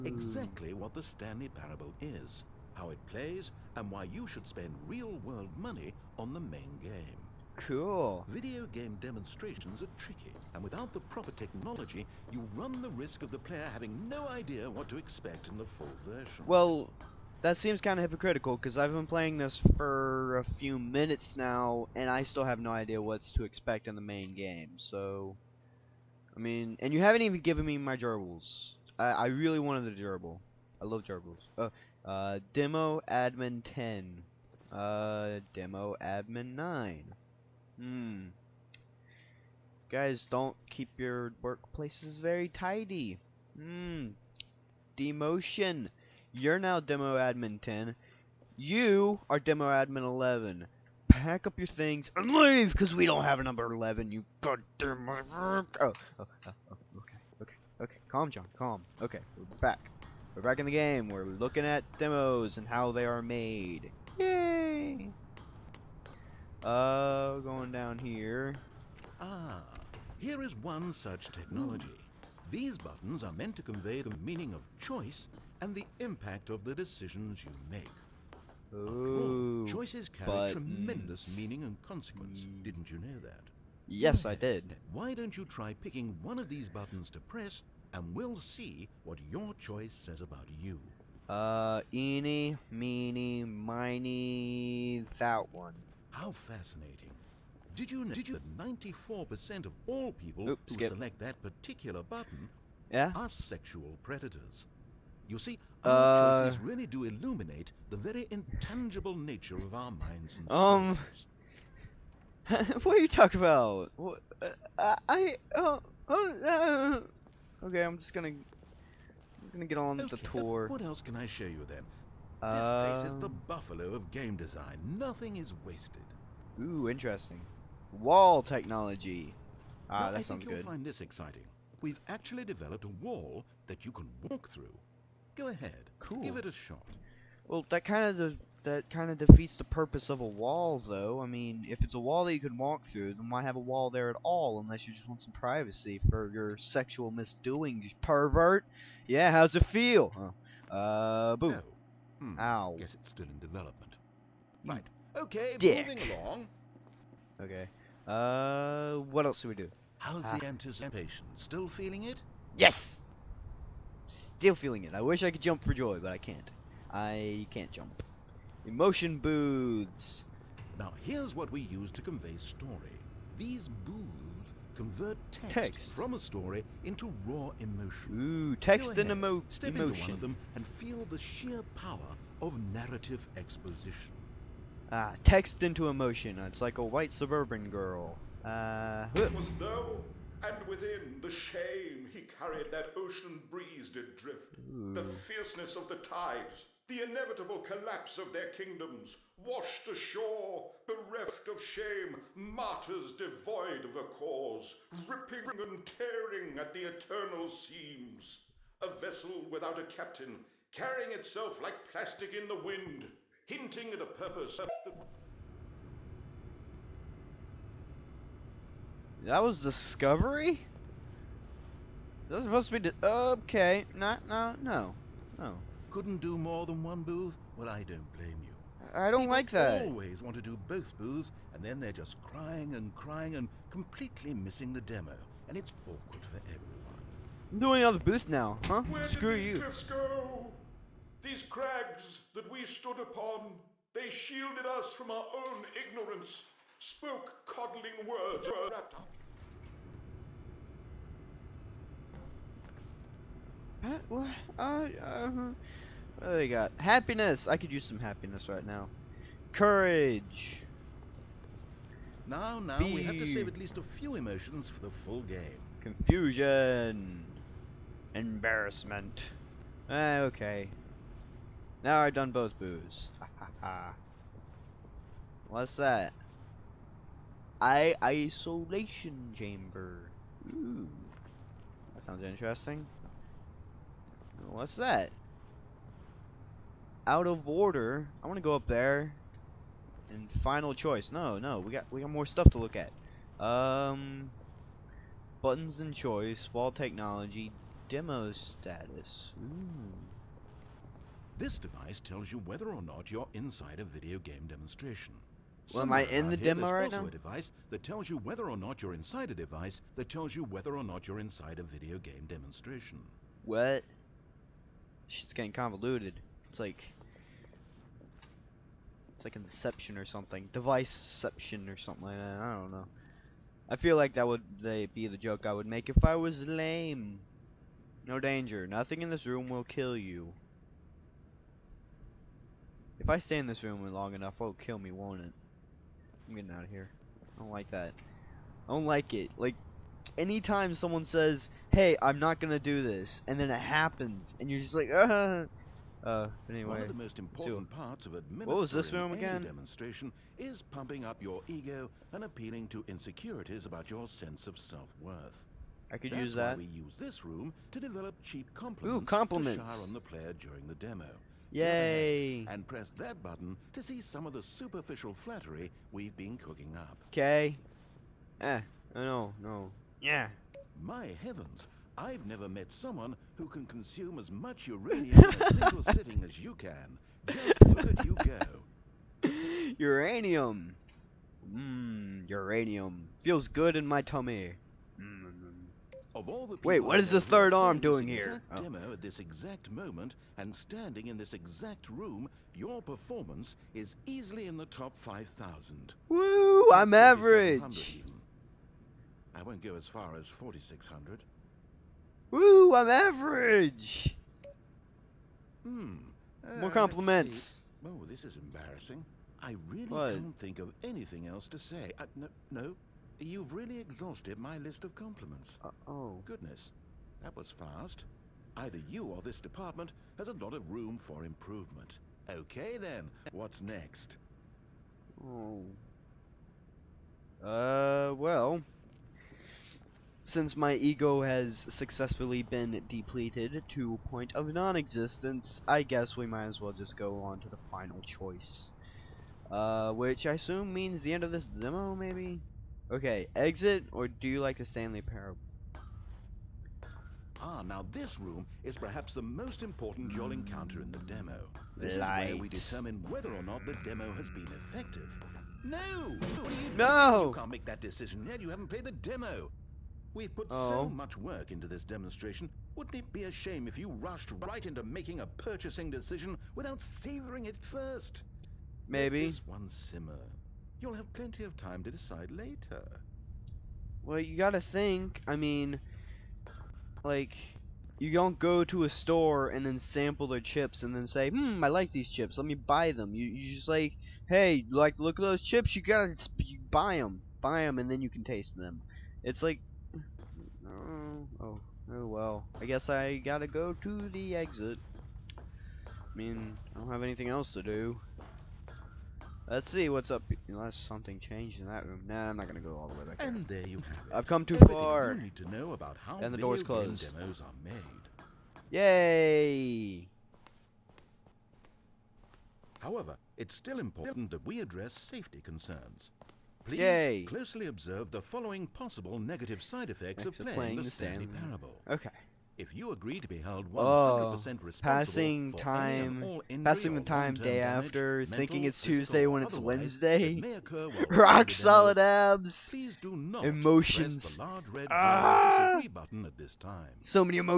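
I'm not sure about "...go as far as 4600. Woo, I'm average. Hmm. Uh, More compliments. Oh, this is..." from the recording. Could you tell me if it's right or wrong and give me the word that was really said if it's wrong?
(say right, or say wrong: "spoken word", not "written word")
right.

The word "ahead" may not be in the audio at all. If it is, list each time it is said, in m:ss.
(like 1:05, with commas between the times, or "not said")
2:15, 2:58.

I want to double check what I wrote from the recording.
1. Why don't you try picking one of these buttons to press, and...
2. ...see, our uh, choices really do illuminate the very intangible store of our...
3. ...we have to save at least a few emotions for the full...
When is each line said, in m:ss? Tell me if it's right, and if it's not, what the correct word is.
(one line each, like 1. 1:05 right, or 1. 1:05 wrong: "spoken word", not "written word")
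1. 1:24 right
2. 1:45 wrong: "nature", not "store"
3. 4:22 right.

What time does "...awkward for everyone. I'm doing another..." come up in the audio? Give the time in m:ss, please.
3:55.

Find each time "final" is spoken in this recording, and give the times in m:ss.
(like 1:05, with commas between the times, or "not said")
4:50, 7:17.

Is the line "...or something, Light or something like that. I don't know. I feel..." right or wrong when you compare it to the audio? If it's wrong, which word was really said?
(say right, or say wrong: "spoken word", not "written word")
wrong: "Deviceception", not "Light".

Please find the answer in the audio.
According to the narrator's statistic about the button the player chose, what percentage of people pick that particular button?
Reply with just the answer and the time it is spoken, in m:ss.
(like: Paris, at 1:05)
94%, at 1:38.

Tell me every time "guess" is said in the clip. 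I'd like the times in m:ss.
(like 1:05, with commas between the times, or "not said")
2:32, 7:15, 8:12.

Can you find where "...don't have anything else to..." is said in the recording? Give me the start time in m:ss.
8:16.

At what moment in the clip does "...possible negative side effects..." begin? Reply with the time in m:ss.
8:38.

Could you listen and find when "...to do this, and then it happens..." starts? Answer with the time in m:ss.
5:42.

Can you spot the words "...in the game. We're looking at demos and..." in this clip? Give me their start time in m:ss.
1:00.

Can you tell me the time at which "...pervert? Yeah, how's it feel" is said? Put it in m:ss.
2:28.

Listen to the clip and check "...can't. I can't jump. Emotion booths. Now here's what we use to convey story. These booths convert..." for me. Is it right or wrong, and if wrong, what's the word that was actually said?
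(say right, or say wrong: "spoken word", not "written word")
right.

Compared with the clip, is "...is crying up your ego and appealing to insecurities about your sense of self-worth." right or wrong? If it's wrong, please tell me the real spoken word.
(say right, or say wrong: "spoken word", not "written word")
wrong: "pumping", not "crying".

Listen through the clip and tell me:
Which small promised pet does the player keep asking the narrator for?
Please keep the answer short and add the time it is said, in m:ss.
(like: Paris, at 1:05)
Gerbil, at 0:30.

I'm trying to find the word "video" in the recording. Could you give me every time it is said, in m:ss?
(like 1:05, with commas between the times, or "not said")
0:08, 5:03, 5:11.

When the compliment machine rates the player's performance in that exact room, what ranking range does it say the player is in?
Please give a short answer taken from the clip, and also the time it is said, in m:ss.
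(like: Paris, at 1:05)
Top 5000, at 6:34.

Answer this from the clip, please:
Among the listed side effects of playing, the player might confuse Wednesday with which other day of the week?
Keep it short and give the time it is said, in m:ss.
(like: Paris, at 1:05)
Tuesday, at 8:48.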